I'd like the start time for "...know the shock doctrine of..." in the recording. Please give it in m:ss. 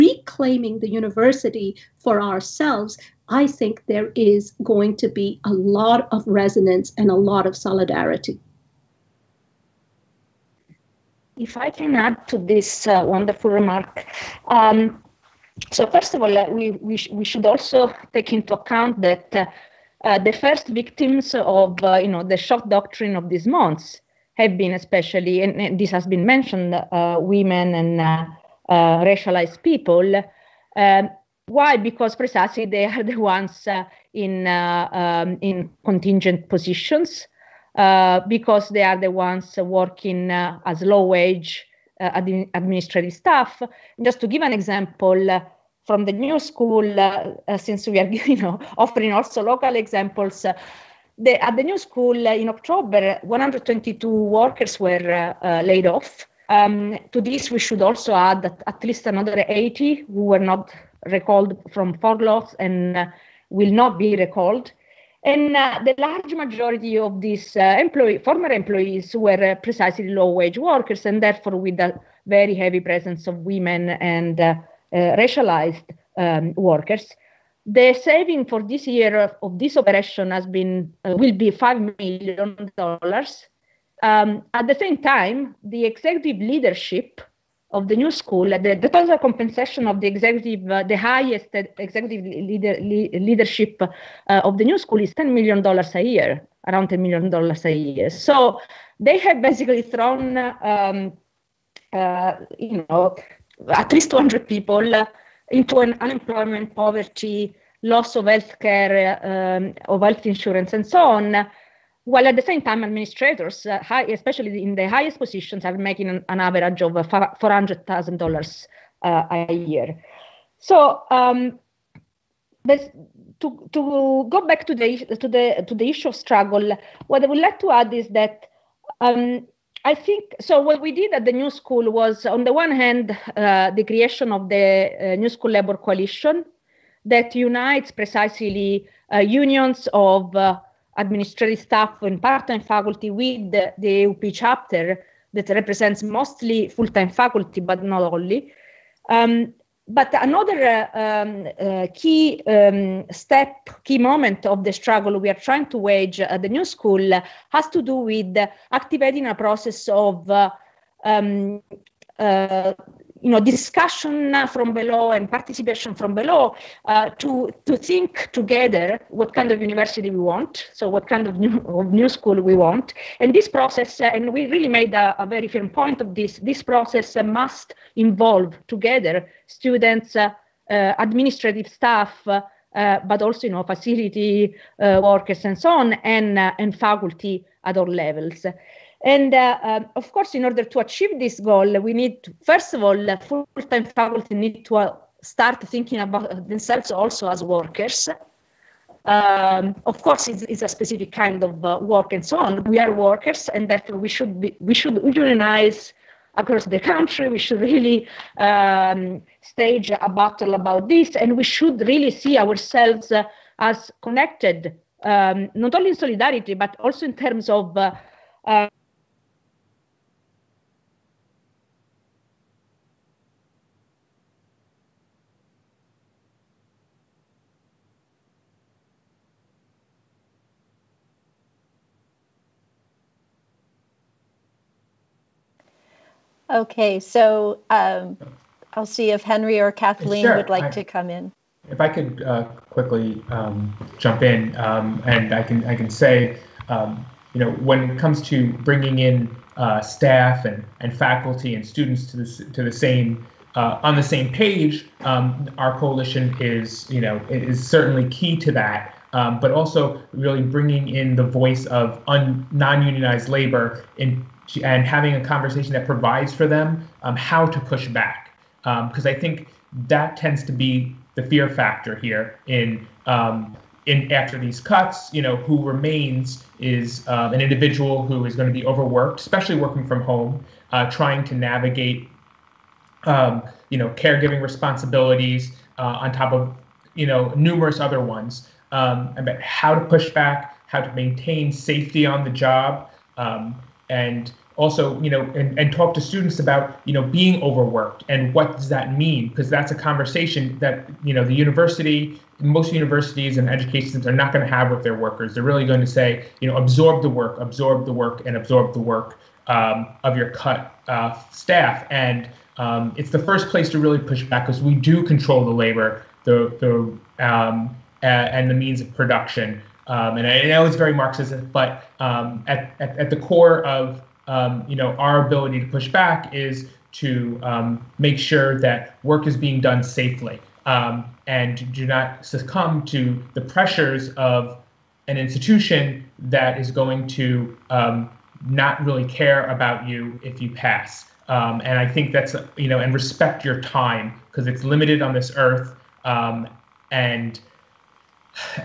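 0:22.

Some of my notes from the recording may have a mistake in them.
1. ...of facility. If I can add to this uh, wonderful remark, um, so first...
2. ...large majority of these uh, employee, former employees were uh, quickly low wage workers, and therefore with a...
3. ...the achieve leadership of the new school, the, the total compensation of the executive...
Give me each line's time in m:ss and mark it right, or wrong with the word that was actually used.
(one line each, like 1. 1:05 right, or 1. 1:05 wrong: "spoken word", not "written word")
1. 0:07 wrong: "solidarity", not "facility"
2. 1:05 wrong: "precisely", not "quickly"
3. 1:25 wrong: "executive", not "achieve".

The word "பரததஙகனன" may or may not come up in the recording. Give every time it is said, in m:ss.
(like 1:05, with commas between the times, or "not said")
not said.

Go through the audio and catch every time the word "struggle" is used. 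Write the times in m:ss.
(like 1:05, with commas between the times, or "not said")
2:06, 2:34.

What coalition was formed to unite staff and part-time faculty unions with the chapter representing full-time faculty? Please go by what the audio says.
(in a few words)
New School Labor Coalition.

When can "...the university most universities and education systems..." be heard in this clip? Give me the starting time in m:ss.
5:01.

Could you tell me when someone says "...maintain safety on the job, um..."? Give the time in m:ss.
4:50.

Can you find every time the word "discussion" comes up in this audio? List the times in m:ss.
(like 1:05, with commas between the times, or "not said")
2:43.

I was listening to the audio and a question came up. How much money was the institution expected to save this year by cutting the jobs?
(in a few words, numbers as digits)
5 million dollars.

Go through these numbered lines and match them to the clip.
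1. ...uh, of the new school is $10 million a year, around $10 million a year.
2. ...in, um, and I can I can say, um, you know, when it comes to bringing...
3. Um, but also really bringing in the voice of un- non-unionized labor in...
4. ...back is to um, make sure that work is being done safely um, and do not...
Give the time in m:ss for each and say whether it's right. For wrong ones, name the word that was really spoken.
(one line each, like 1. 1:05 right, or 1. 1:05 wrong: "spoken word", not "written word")
1. 1:33 right
2. 4:04 right
3. 4:19 right
4. 5:25 right.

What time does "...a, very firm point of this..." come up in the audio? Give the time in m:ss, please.
2:55.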